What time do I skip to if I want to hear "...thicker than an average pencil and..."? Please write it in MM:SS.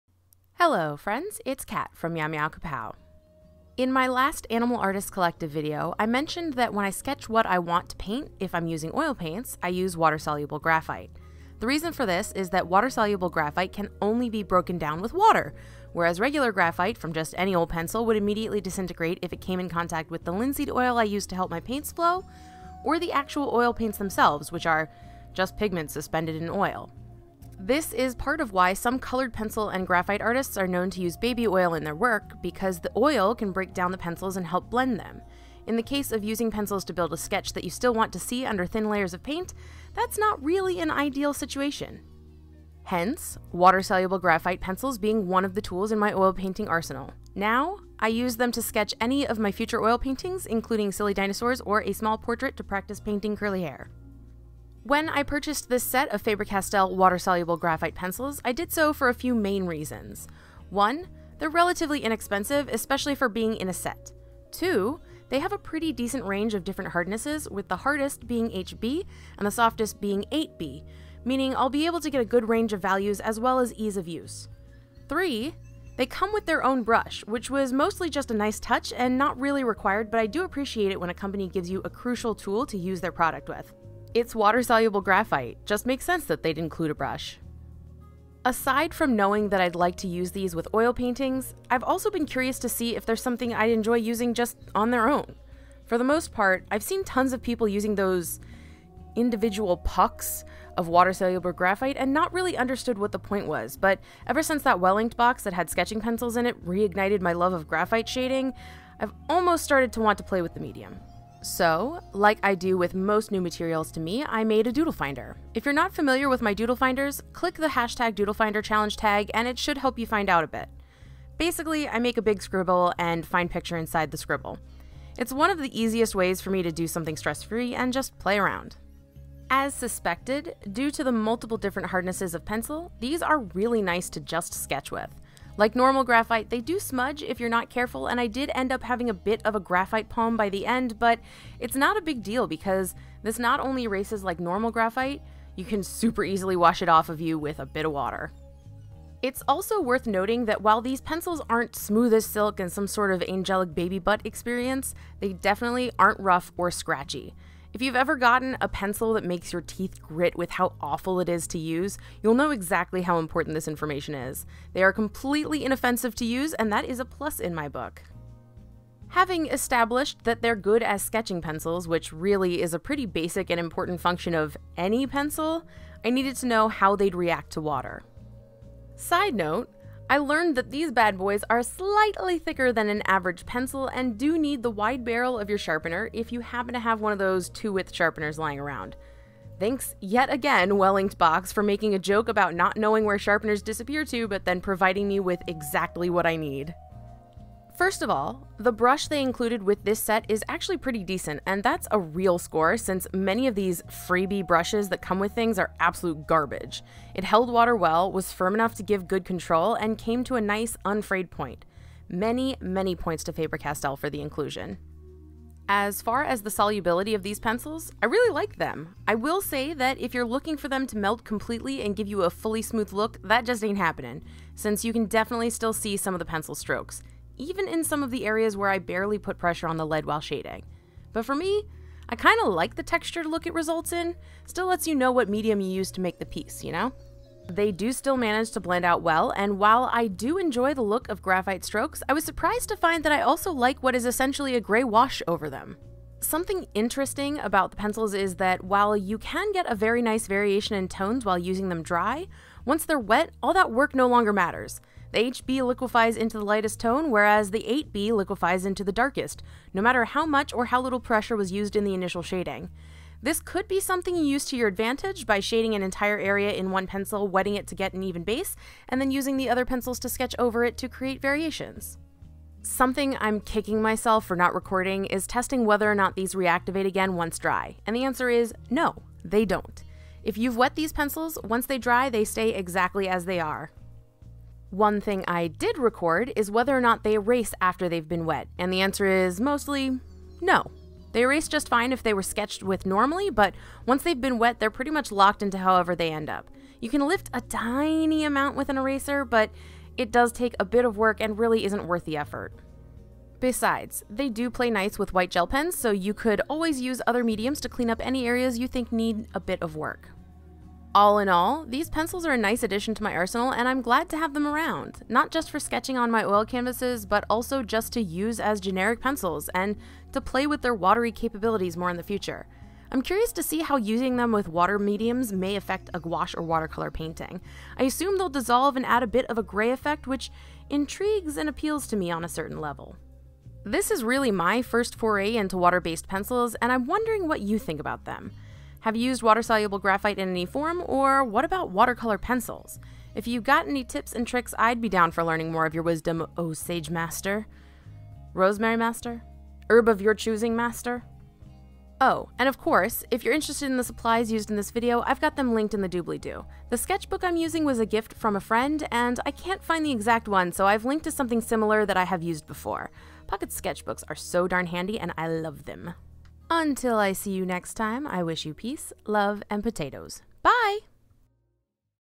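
03:02.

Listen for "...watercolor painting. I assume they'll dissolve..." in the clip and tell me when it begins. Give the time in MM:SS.
05:26.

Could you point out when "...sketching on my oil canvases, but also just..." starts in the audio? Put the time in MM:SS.
05:15.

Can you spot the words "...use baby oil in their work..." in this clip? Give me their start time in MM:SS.
00:31.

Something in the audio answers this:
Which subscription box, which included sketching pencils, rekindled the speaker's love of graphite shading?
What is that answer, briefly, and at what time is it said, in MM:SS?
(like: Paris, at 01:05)
Well Inked Box, at 01:44.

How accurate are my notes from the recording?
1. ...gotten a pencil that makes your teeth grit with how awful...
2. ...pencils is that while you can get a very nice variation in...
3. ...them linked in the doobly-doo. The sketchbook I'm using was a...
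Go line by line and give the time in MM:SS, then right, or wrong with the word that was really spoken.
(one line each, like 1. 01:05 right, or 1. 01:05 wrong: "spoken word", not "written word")
1. 02:38 right
2. 04:07 right
3. 05:55 right.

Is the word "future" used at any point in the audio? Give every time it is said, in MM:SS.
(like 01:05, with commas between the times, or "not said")
00:49, 05:22.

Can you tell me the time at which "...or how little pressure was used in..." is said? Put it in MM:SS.
04:20.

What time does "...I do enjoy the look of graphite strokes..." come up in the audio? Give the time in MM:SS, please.
03:59.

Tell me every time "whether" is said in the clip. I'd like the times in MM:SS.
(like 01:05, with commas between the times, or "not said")
04:35, 04:46.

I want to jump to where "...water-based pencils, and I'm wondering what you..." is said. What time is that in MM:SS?
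05:35.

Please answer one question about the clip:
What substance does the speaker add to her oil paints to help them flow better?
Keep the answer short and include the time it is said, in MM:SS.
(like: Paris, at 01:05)
Linseed oil, at 00:20.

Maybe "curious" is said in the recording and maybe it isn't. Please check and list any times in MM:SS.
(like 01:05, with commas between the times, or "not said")
01:32, 05:23.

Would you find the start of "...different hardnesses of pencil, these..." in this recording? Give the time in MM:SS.
02:11.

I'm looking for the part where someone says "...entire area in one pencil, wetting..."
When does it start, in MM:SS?
04:25.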